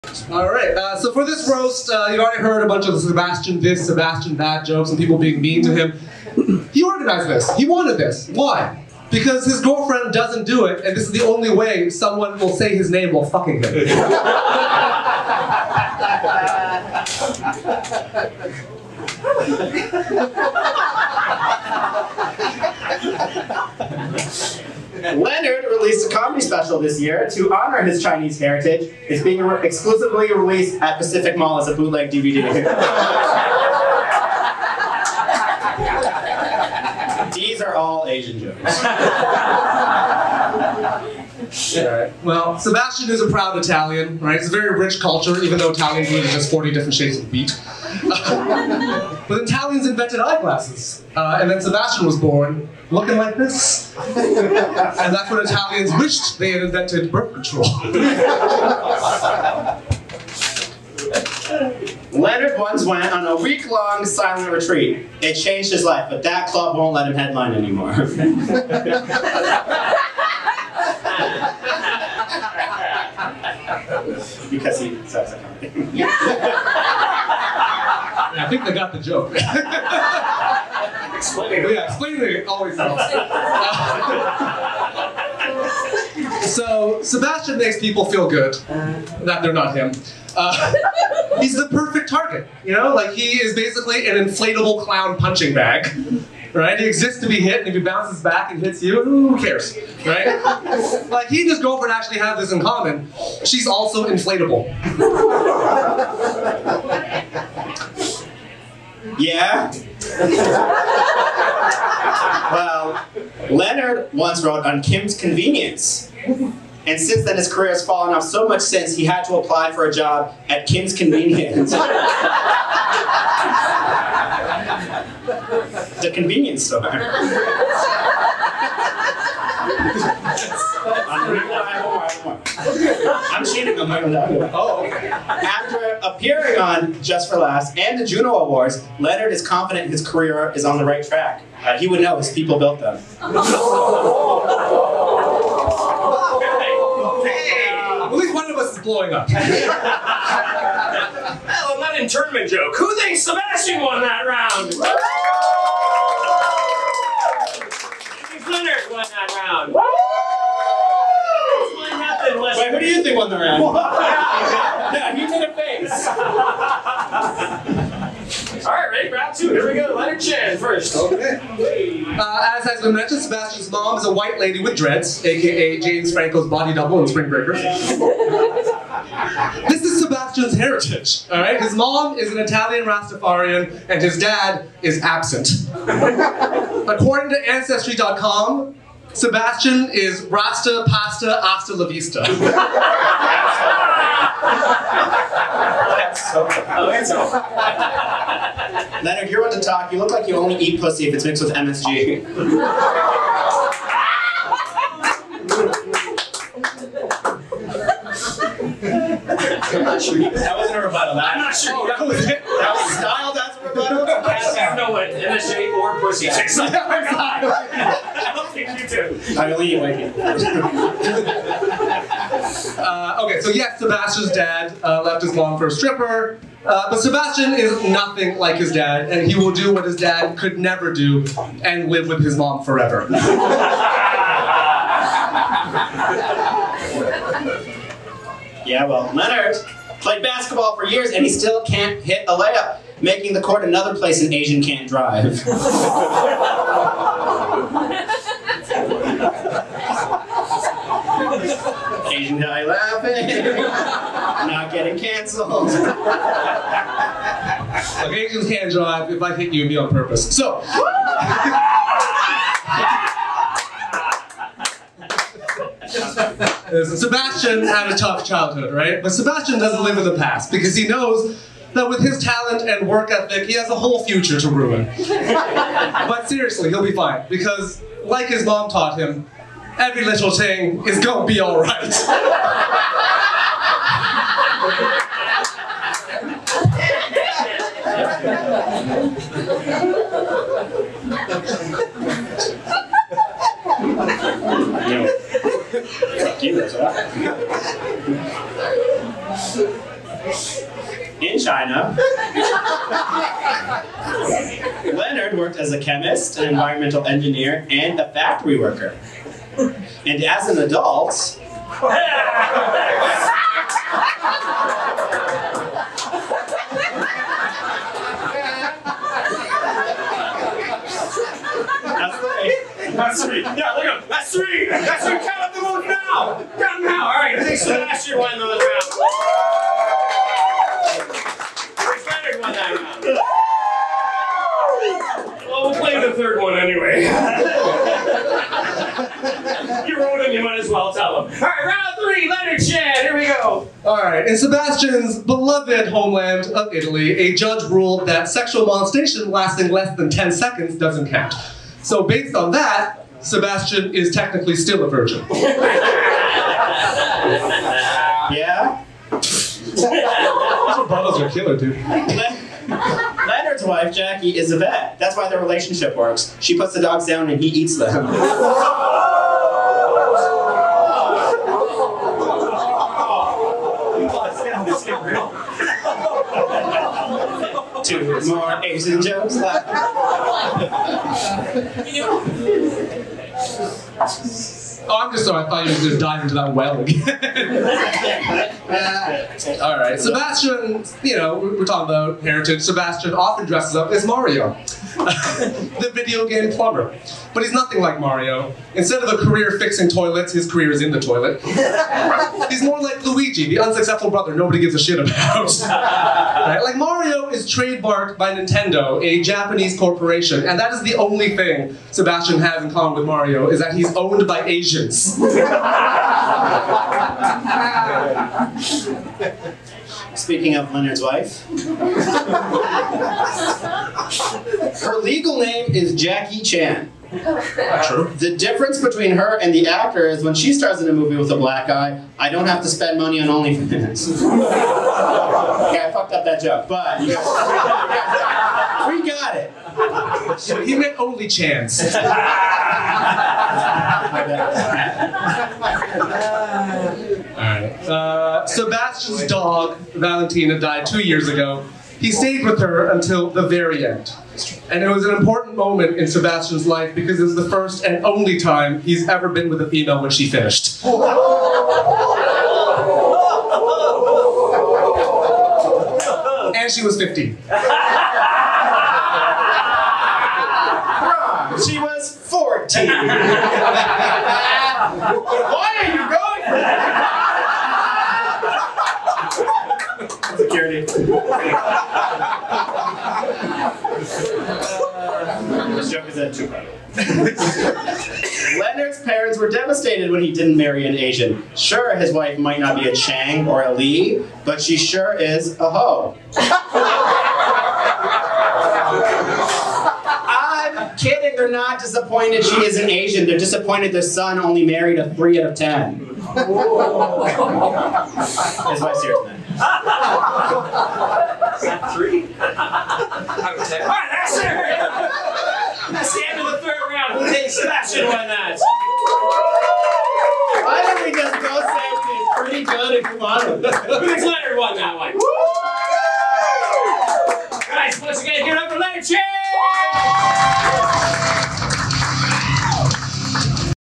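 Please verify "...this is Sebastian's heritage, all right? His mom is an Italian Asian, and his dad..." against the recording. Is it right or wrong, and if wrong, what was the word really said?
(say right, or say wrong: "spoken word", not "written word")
wrong: "Rastafarian", not "Asian".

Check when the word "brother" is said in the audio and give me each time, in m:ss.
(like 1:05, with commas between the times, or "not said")
6:44.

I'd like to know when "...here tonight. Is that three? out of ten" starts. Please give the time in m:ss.
8:29.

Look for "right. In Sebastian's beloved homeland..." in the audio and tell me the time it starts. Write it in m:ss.
5:44.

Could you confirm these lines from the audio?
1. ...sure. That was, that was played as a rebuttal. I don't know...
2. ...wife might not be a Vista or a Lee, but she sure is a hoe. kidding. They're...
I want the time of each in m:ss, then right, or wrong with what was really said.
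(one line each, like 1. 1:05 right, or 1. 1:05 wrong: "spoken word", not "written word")
1. 3:31 wrong: "styled", not "played"
2. 8:12 wrong: "Chang", not "Vista".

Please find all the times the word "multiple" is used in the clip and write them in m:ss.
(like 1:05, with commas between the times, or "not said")
not said.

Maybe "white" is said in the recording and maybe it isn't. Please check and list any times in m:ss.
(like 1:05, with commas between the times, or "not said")
2:54, 3:39.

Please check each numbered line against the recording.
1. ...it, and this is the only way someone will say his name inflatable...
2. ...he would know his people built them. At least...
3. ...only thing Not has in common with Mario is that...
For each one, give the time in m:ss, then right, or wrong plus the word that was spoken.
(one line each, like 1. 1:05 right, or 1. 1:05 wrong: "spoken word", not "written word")
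1. 0:10 wrong: "while", not "inflatable"
2. 2:21 right
3. 6:50 wrong: "Sebastian", not "Not".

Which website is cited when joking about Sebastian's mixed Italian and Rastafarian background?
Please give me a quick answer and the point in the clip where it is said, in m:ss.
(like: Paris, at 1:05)
Ancestry.com, at 3:07.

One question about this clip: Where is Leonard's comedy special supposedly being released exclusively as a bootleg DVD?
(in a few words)
Pacific Mall.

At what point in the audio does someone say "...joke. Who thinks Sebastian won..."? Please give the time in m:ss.
2:32.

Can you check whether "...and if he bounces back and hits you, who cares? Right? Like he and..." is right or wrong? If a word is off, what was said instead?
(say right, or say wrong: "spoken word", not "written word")
right.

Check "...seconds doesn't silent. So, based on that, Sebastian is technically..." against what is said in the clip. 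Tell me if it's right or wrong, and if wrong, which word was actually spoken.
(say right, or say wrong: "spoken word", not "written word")
wrong: "count", not "silent".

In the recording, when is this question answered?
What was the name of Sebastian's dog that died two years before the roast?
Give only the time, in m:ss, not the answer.
7:29.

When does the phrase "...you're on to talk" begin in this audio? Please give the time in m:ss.
3:19.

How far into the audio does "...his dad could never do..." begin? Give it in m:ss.
3:49.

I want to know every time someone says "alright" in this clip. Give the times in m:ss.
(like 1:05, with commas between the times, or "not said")
4:41, 7:23.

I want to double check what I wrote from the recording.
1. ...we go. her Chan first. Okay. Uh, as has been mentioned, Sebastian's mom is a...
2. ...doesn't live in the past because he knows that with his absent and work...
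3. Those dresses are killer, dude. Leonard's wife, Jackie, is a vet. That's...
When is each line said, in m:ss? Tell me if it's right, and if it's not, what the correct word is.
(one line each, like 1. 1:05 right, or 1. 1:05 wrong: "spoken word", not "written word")
1. 2:49 right
2. 4:29 wrong: "talent", not "absent"
3. 5:59 wrong: "bottles", not "dresses".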